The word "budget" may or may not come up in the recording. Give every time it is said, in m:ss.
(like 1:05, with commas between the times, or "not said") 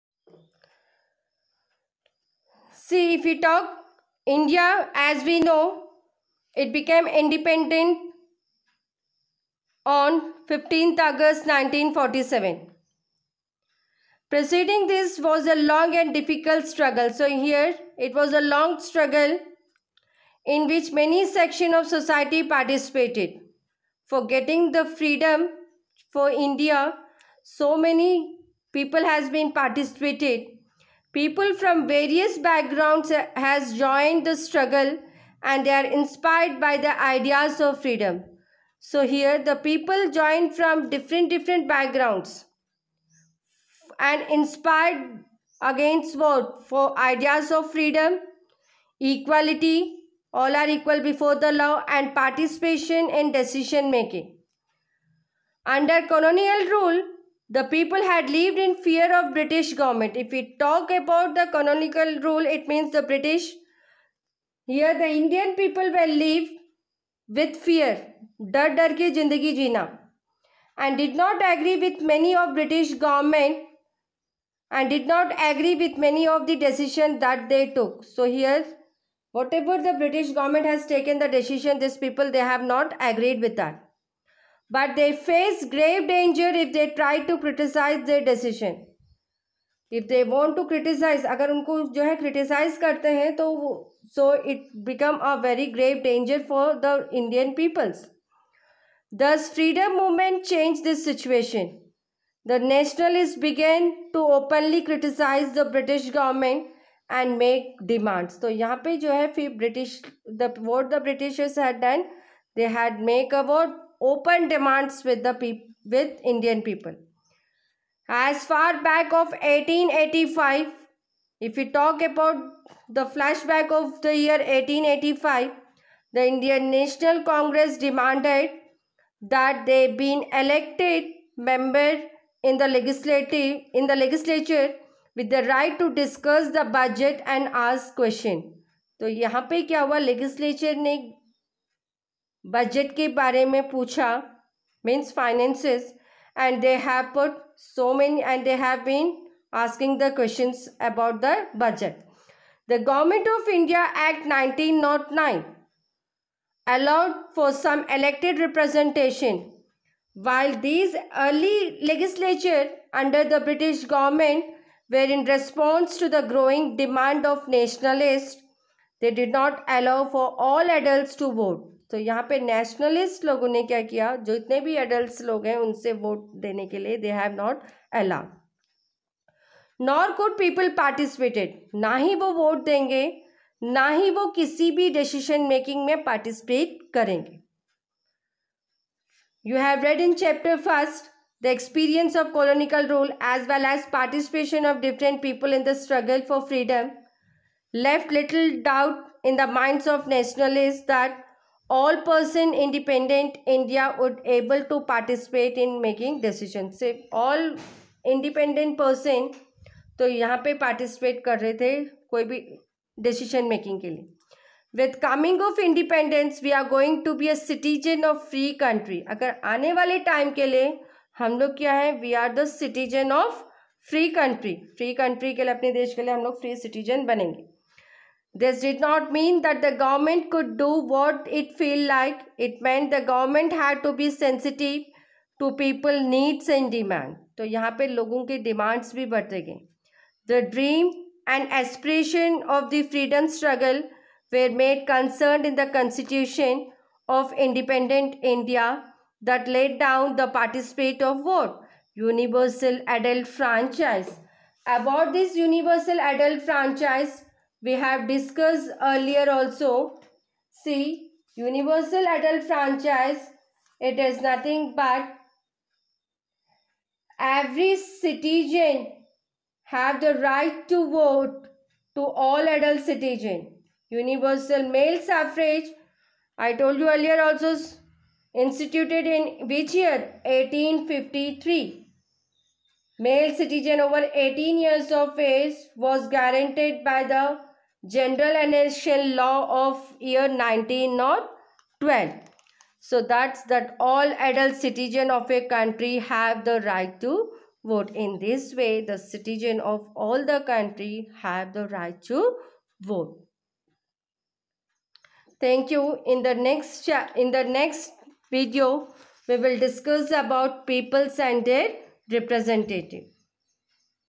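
2:16, 2:22, 2:31.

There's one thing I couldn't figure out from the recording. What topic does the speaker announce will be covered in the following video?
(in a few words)
Peoples and their representative.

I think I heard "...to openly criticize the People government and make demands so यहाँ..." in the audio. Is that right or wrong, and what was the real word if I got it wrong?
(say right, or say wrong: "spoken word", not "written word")
wrong: "British", not "People".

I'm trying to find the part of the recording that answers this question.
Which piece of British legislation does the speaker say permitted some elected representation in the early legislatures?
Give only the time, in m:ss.
2:32.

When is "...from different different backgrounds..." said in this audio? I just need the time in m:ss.
0:40.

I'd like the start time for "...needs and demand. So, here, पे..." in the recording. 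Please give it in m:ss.
3:56.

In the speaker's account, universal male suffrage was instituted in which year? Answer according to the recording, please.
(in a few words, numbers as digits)
1853.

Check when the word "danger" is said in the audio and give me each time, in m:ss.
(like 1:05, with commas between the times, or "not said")
1:26, 1:36.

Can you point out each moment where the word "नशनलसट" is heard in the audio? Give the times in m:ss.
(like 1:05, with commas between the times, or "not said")
2:52, 3:20.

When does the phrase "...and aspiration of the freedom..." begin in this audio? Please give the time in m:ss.
4:01.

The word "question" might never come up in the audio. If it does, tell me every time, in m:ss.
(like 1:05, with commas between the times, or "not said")
2:17, 2:30.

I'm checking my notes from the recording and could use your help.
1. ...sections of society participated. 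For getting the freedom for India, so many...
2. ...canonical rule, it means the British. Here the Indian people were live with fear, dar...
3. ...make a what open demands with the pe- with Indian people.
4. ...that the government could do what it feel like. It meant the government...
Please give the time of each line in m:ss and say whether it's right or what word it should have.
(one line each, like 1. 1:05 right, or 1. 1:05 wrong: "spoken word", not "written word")
1. 0:21 right
2. 1:01 right
3. 1:53 right
4. 3:49 right.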